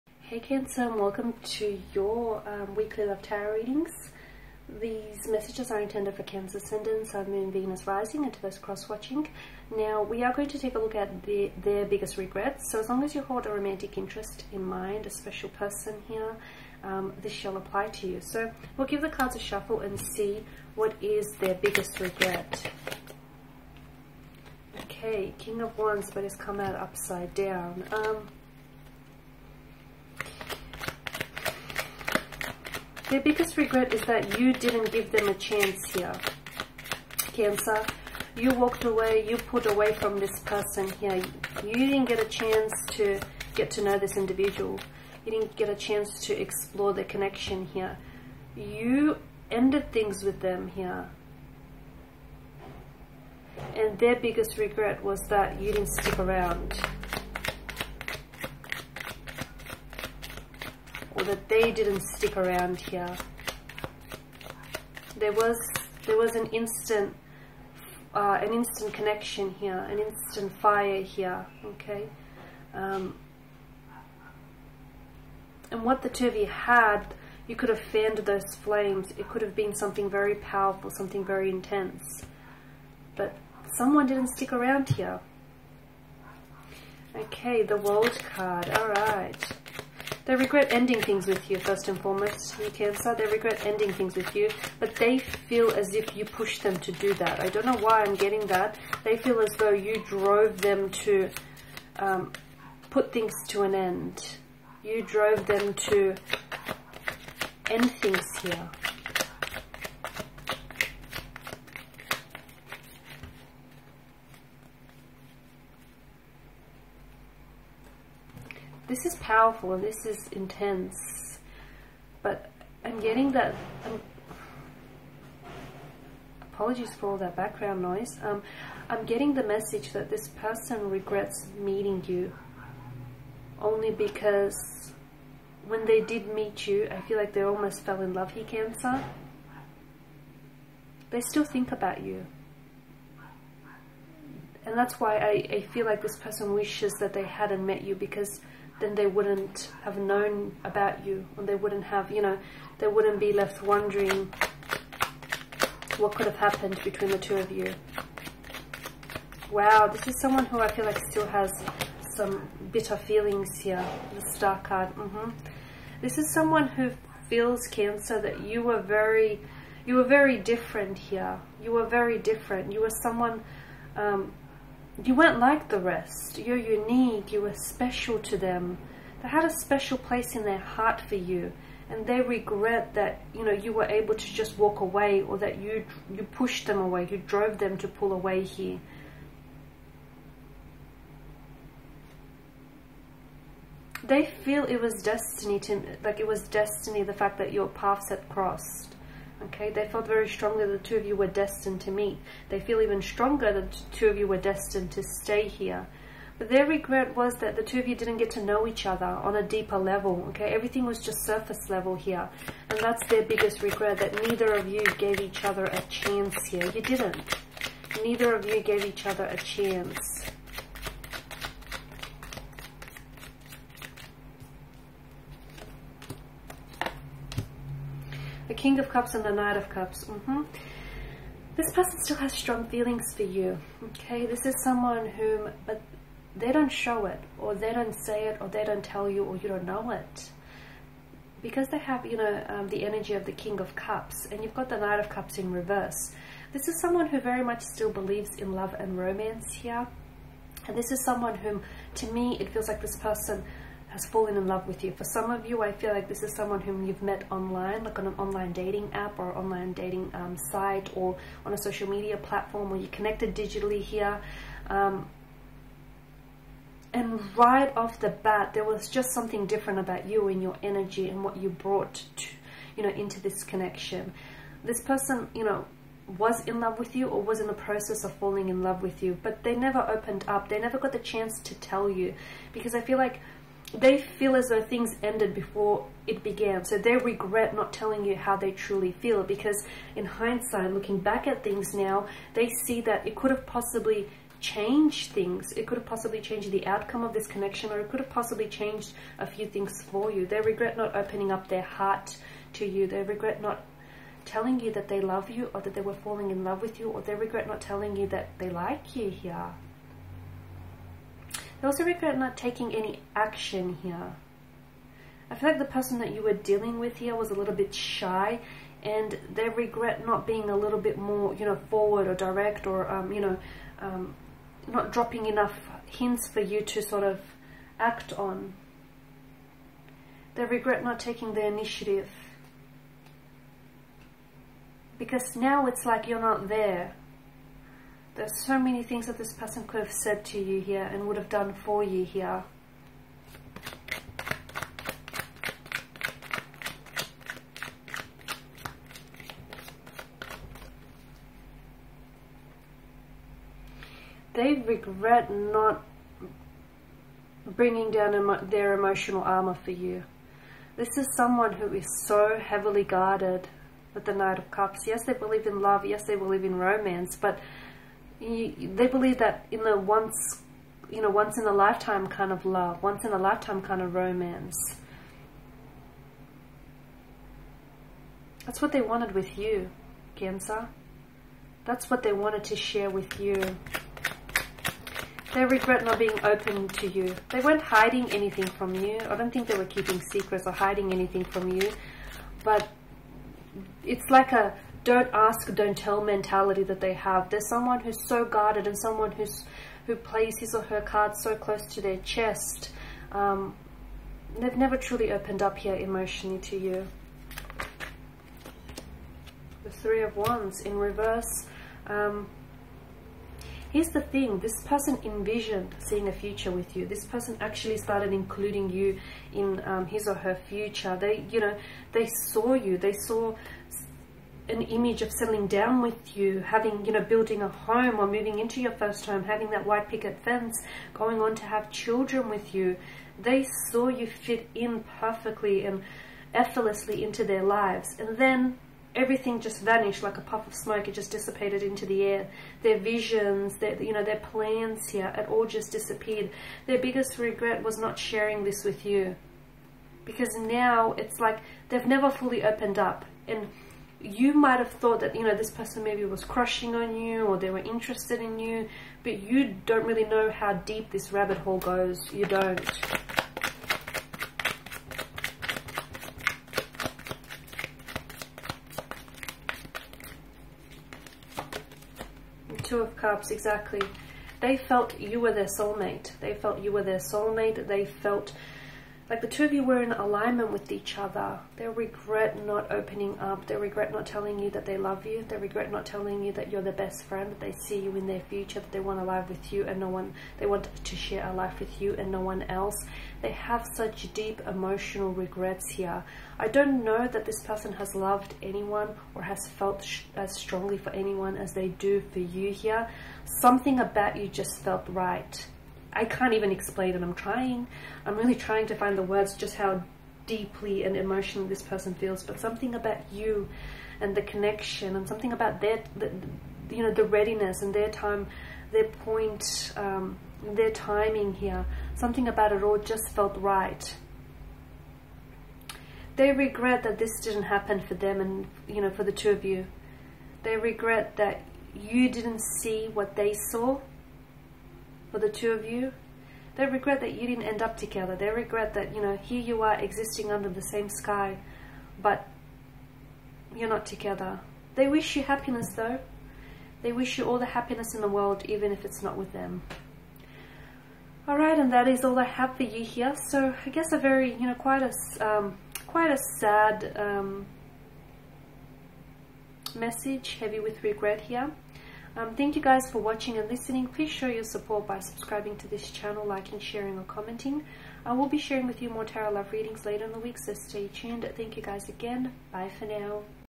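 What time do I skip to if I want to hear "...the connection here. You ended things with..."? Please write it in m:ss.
0:46.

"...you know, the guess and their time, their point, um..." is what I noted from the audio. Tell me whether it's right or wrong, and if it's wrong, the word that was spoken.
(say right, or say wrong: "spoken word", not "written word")
wrong: "readiness", not "guess".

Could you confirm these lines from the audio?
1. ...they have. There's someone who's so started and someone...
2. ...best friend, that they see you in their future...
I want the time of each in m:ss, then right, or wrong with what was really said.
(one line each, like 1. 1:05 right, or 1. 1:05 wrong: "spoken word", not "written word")
1. 6:36 wrong: "guarded", not "started"
2. 8:06 right.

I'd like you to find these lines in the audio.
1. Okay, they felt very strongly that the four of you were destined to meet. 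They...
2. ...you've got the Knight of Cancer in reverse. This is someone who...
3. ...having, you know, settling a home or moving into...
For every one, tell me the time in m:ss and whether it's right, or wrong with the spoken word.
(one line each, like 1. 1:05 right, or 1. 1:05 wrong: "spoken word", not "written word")
1. 3:19 wrong: "two", not "four"
2. 4:04 wrong: "Cups", not "Cancer"
3. 7:06 wrong: "building", not "settling".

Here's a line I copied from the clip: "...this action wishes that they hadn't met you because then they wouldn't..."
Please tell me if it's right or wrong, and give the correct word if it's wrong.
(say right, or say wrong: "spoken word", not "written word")
wrong: "person", not "action".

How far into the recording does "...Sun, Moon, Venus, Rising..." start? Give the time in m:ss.
0:07.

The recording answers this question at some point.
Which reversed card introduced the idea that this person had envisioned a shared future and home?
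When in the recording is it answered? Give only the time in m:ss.
6:49.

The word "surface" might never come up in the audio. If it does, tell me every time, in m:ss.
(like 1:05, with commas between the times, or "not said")
3:31.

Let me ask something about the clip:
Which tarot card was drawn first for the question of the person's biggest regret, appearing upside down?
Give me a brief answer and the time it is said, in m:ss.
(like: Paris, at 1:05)
King of Wands, at 0:25.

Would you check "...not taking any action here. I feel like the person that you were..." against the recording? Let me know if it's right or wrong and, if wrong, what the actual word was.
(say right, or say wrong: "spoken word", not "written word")
right.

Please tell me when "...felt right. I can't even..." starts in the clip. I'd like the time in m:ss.
8:24.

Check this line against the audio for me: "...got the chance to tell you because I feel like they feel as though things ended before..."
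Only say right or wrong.
right.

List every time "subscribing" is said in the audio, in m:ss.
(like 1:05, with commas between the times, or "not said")
9:24.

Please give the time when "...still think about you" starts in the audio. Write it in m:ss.
2:21.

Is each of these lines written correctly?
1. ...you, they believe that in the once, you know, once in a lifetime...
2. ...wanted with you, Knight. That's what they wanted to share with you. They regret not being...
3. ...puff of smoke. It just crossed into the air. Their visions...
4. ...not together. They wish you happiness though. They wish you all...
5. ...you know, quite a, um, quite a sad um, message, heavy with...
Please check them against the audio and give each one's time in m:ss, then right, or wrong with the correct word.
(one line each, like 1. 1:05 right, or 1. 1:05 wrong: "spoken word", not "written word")
1. 6:08 right
2. 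6:18 wrong: "Cancer", not "Knight"
3. 7:20 wrong: "dissipated", not "crossed"
4. 9:03 right
5. 9:14 right.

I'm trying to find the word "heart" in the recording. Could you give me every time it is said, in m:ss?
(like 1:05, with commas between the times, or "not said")
3:00, 5:01.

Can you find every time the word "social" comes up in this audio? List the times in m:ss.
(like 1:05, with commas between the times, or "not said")
4:21.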